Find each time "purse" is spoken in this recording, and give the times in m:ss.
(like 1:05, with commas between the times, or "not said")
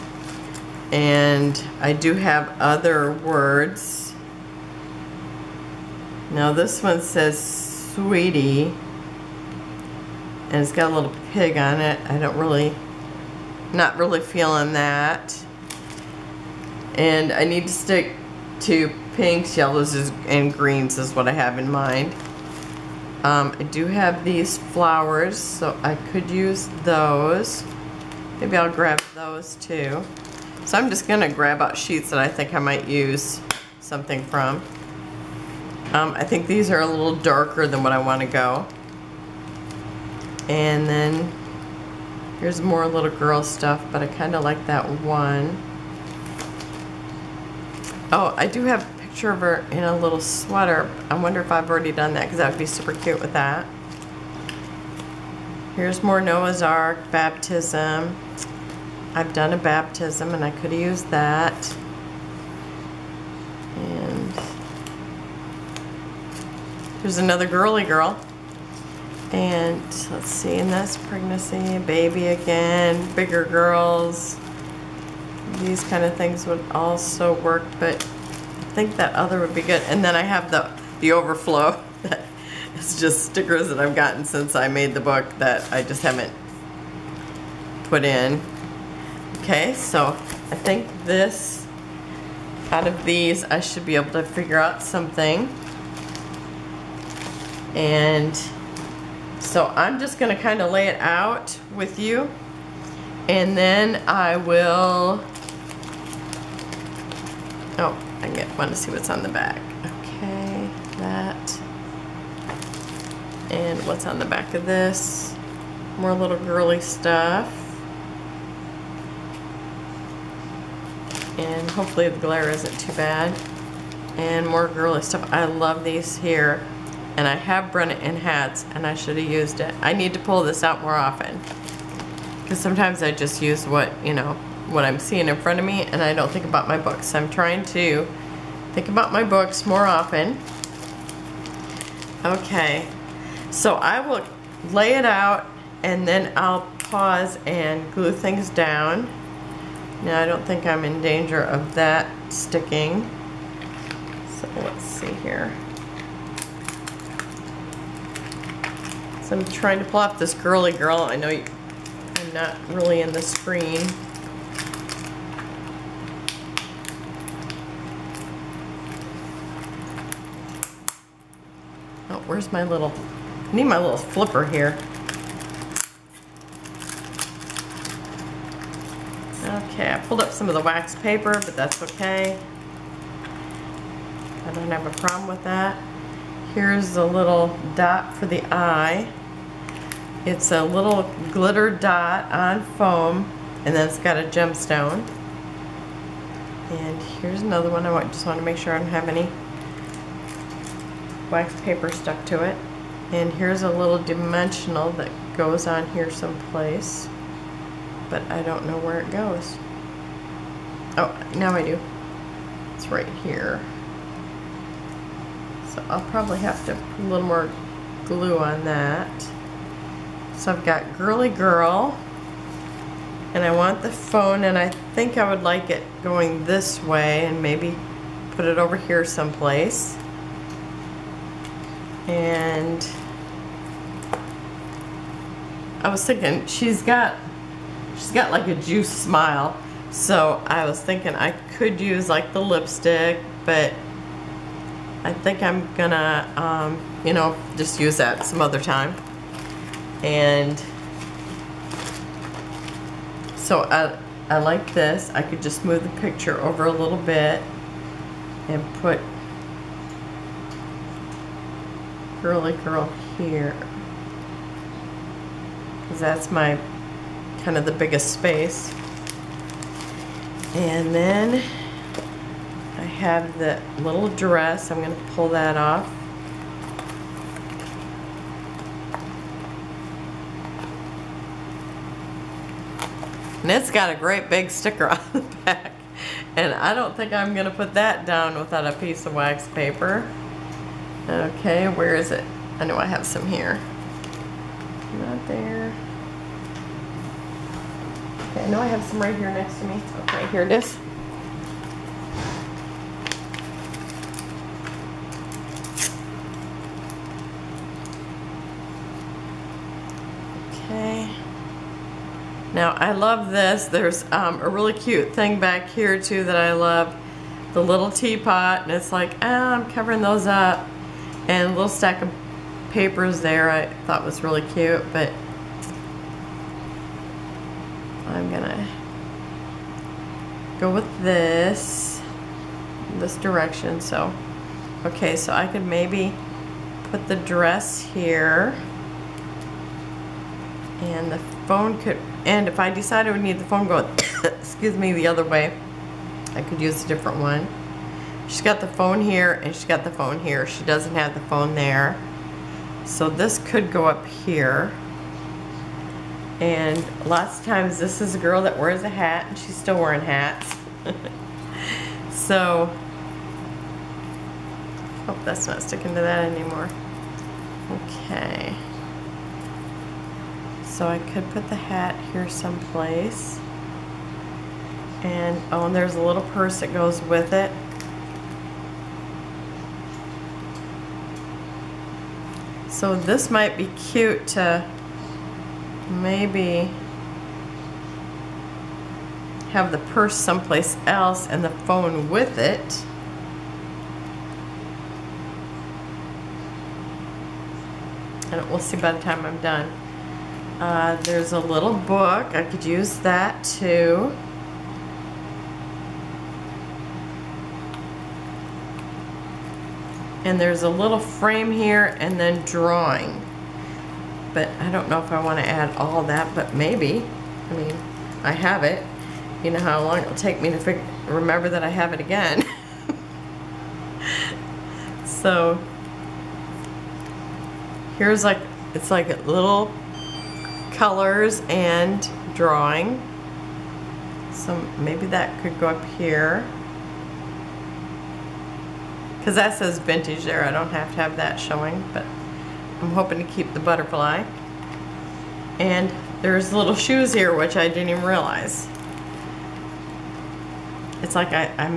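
6:16, 6:29.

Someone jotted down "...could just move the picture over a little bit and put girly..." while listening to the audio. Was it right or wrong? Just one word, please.
right.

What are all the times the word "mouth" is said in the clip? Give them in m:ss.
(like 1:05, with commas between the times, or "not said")
not said.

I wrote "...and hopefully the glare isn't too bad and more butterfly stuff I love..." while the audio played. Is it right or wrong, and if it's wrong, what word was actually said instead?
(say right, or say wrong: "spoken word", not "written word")
wrong: "girly", not "butterfly".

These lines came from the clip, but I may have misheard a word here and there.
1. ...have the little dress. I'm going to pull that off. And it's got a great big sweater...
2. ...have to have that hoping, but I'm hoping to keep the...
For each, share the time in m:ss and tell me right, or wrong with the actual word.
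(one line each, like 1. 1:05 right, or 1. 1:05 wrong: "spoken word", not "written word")
1. 4:32 wrong: "sticker", not "sweater"
2. 7:20 wrong: "showing", not "hoping".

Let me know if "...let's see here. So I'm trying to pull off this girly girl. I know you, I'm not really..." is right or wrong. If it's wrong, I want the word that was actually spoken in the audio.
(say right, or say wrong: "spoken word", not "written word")
right.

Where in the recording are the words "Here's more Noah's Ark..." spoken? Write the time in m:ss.
0:55.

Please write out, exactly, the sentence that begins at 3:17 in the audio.
I just want to make sure I don't have any wax paper stuck to it.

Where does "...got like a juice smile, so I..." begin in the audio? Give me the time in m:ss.
3:58.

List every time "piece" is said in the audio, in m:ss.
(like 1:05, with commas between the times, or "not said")
4:48.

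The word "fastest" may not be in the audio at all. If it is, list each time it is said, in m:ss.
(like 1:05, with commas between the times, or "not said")
not said.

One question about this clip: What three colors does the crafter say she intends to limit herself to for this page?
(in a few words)
pinks, yellows, and greens.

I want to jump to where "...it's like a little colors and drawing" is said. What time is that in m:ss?
7:08.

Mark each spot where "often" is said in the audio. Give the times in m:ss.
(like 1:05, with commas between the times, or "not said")
2:10, 2:19.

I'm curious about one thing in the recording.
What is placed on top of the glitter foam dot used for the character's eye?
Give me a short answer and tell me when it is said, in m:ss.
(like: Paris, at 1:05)
a gemstone, at 3:14.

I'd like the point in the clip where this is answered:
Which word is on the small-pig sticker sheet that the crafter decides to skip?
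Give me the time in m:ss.
0:07.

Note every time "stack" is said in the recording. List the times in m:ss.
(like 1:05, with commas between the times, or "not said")
5:21.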